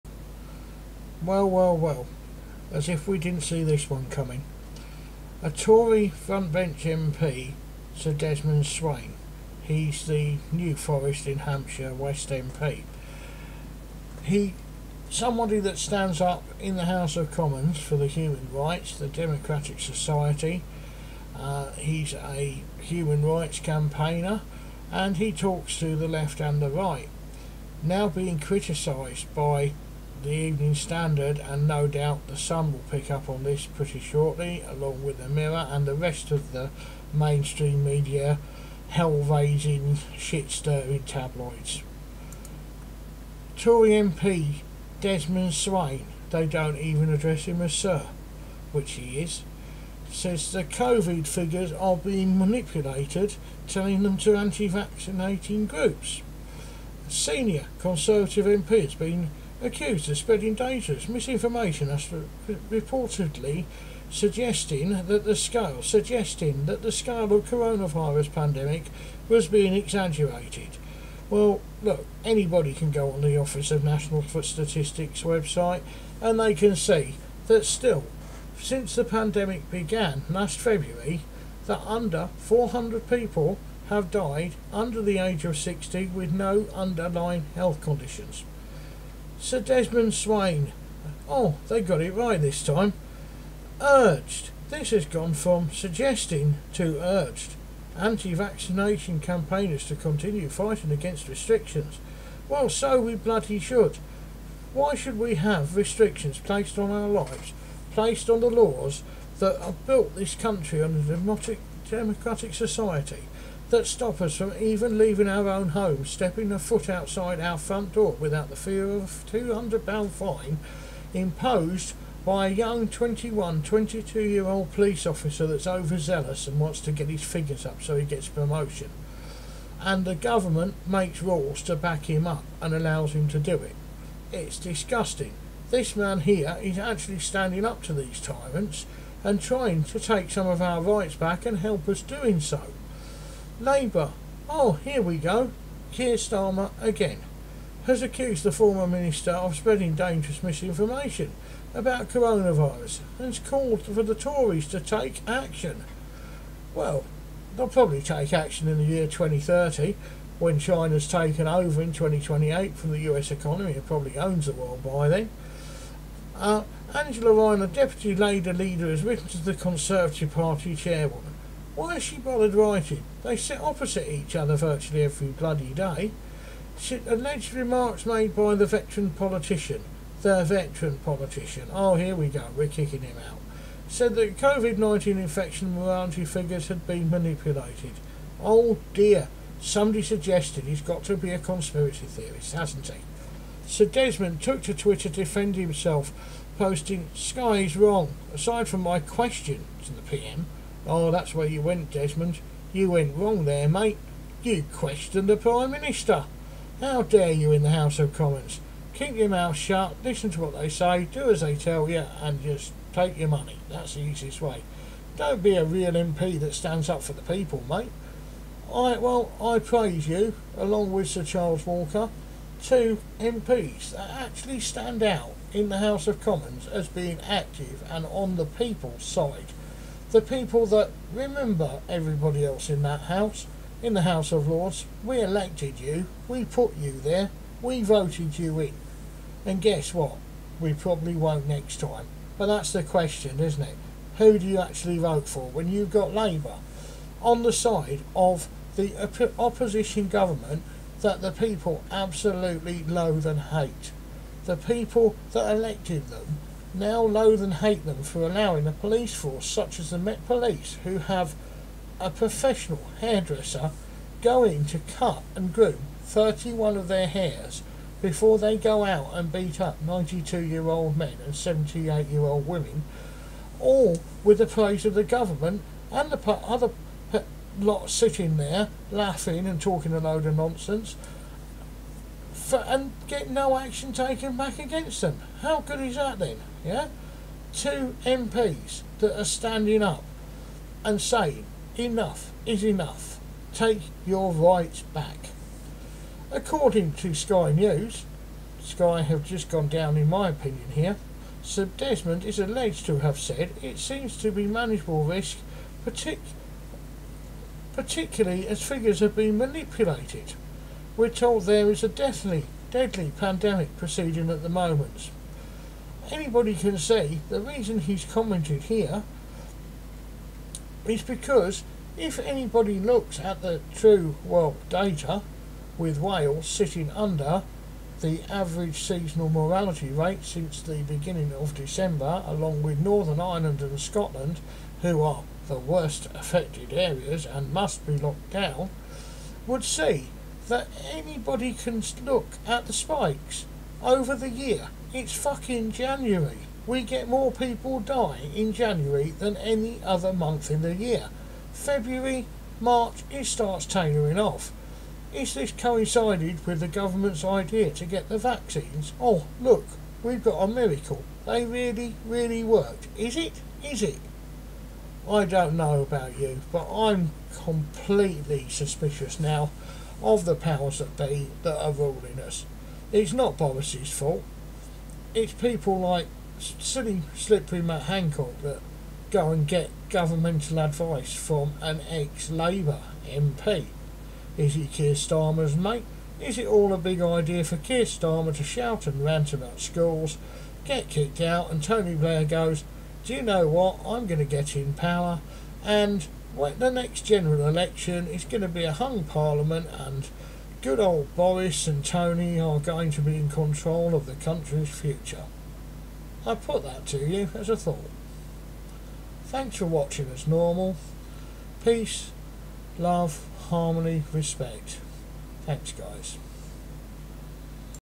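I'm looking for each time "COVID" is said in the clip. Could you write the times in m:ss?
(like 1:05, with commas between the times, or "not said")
0:50, 3:04.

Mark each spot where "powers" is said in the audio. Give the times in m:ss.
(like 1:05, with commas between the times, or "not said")
6:10, 6:34.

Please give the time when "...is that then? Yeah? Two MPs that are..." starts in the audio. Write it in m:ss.
4:45.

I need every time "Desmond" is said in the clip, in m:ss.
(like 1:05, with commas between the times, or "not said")
0:08, 0:44, 1:29, 3:13, 3:21, 5:01.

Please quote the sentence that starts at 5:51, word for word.
February, March, it starts tailoring off.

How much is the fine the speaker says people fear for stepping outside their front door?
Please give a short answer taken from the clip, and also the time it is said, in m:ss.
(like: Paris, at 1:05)
£200, at 1:59.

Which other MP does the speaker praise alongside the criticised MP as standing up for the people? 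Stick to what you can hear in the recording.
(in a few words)
Sir Charles Walker.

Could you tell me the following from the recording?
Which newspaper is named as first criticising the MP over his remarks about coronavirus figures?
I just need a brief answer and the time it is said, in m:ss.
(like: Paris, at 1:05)
Evening Standard, at 0:30.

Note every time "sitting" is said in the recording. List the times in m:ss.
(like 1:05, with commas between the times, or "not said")
4:37, 5:26.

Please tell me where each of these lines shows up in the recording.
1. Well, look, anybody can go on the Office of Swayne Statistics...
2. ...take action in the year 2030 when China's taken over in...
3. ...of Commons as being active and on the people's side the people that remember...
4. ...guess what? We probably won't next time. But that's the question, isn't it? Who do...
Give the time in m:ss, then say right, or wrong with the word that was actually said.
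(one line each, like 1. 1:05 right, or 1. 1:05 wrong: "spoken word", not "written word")
1. 1:11 wrong: "National", not "Swayne"
2. 2:38 right
3. 3:46 right
4. 3:59 right.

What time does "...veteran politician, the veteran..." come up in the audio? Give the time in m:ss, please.
2:58.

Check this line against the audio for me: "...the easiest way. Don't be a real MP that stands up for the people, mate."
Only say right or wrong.
right.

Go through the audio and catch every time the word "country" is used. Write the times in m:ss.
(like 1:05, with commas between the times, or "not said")
1:50, 6:44.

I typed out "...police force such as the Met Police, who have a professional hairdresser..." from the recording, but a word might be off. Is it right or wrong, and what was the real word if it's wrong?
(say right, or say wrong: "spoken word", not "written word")
right.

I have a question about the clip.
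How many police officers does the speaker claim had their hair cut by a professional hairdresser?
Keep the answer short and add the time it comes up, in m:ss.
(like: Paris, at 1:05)
31, at 4:26.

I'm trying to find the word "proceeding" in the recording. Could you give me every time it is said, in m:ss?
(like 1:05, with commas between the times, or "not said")
5:13.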